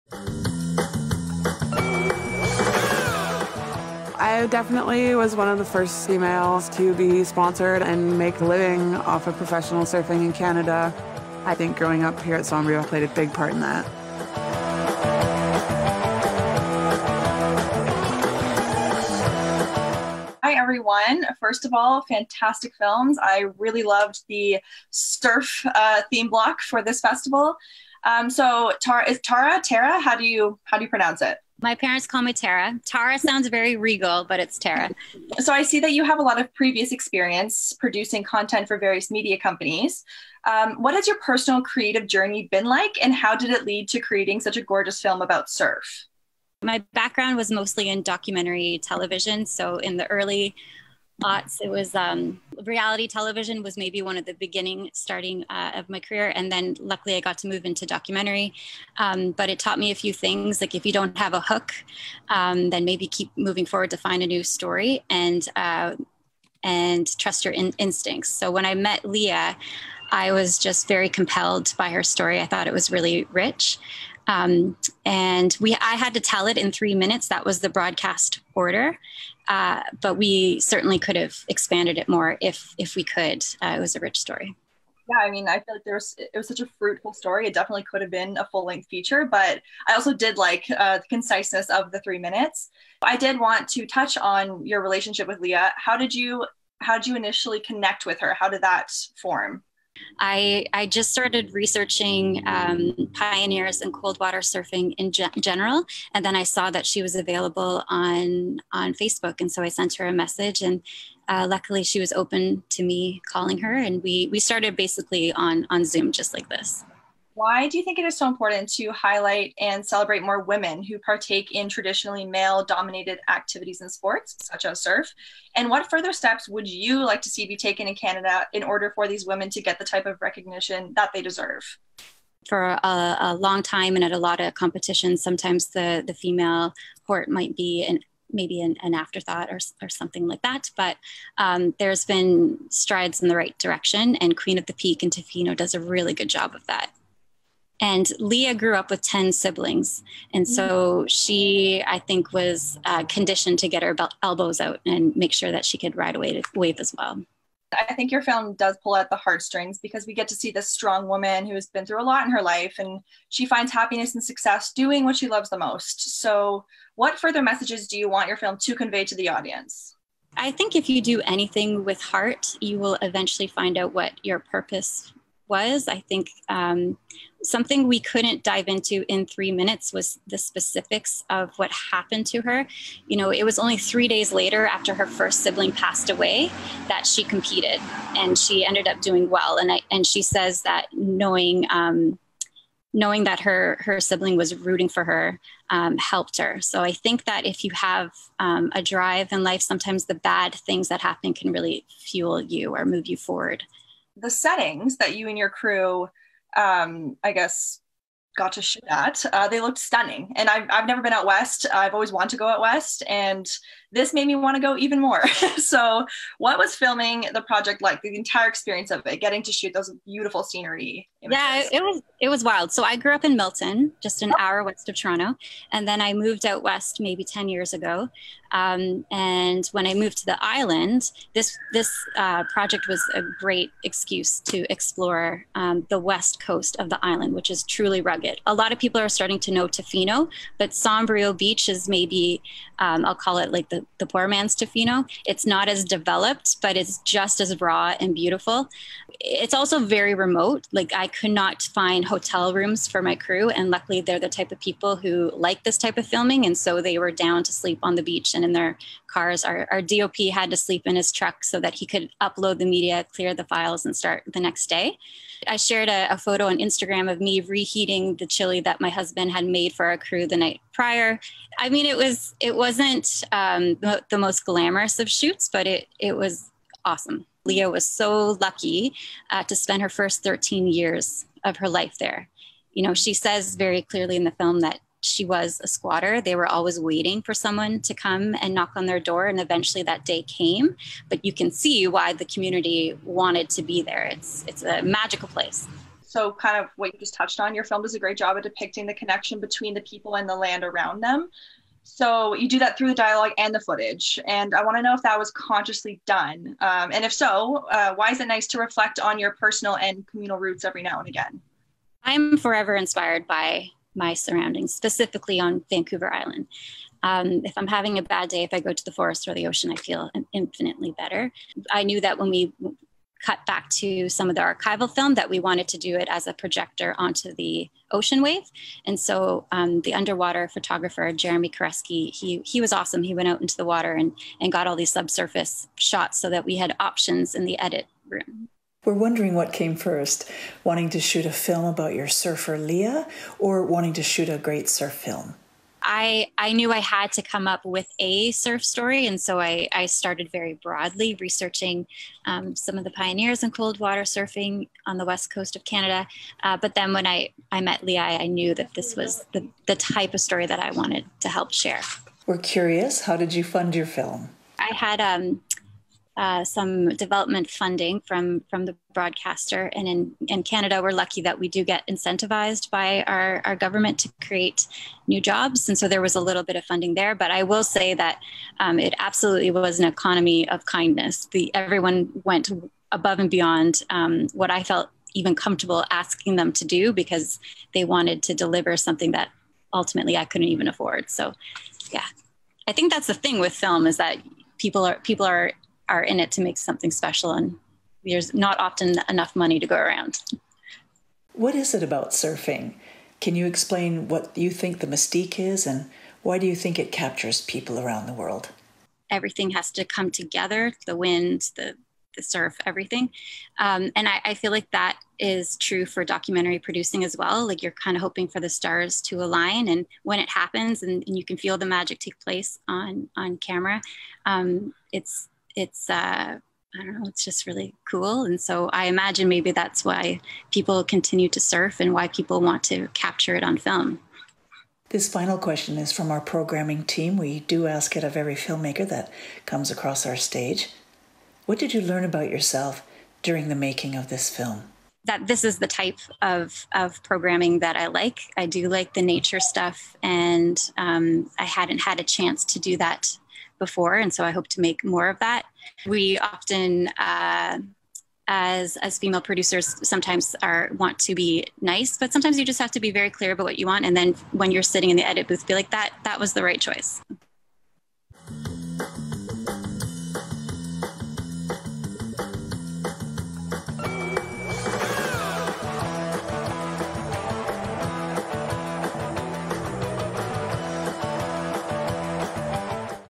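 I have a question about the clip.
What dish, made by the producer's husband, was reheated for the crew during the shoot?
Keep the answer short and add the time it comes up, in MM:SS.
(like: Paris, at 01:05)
chili, at 04:28.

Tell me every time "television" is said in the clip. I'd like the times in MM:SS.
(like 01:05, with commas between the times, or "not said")
00:48, 00:53.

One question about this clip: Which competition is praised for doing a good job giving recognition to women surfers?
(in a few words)
Queen of the Peak.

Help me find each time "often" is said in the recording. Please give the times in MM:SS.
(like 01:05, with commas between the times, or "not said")
06:38, 07:36.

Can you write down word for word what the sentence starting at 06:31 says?
So, yeah, I think that's the thing with film is that people are people are are in it to make something special.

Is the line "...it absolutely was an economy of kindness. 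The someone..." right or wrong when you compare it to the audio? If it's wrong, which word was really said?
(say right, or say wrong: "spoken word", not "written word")
wrong: "everyone", not "someone".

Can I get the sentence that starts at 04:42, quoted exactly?
You know, she says very clearly in the film that she was a squatter.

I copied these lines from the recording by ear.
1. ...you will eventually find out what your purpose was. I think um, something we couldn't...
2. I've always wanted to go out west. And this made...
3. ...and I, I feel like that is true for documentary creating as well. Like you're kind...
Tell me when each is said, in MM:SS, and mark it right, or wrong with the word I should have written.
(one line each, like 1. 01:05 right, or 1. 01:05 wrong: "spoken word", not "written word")
1. 02:52 right
2. 03:31 right
3. 06:53 wrong: "producing", not "creating".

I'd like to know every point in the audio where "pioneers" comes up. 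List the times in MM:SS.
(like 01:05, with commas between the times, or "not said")
01:43, 05:52.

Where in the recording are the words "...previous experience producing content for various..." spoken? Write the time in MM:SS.
00:36.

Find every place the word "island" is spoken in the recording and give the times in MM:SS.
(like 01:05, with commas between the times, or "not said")
03:50, 03:57, 05:16.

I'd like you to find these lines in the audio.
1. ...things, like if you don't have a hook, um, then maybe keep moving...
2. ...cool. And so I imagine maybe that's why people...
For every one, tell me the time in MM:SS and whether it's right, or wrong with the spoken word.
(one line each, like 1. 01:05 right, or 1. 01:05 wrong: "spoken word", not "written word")
1. 01:00 right
2. 07:07 right.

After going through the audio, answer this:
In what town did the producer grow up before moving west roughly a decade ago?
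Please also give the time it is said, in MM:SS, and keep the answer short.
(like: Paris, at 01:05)
Milton, at 03:43.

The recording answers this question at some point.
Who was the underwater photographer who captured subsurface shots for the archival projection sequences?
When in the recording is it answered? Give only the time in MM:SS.
05:31.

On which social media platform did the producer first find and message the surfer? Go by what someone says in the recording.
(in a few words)
Facebook.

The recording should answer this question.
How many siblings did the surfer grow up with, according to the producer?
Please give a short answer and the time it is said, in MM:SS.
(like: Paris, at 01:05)
10, at 02:29.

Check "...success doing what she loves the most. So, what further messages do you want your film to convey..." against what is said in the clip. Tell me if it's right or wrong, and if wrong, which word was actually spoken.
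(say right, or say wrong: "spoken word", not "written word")
right.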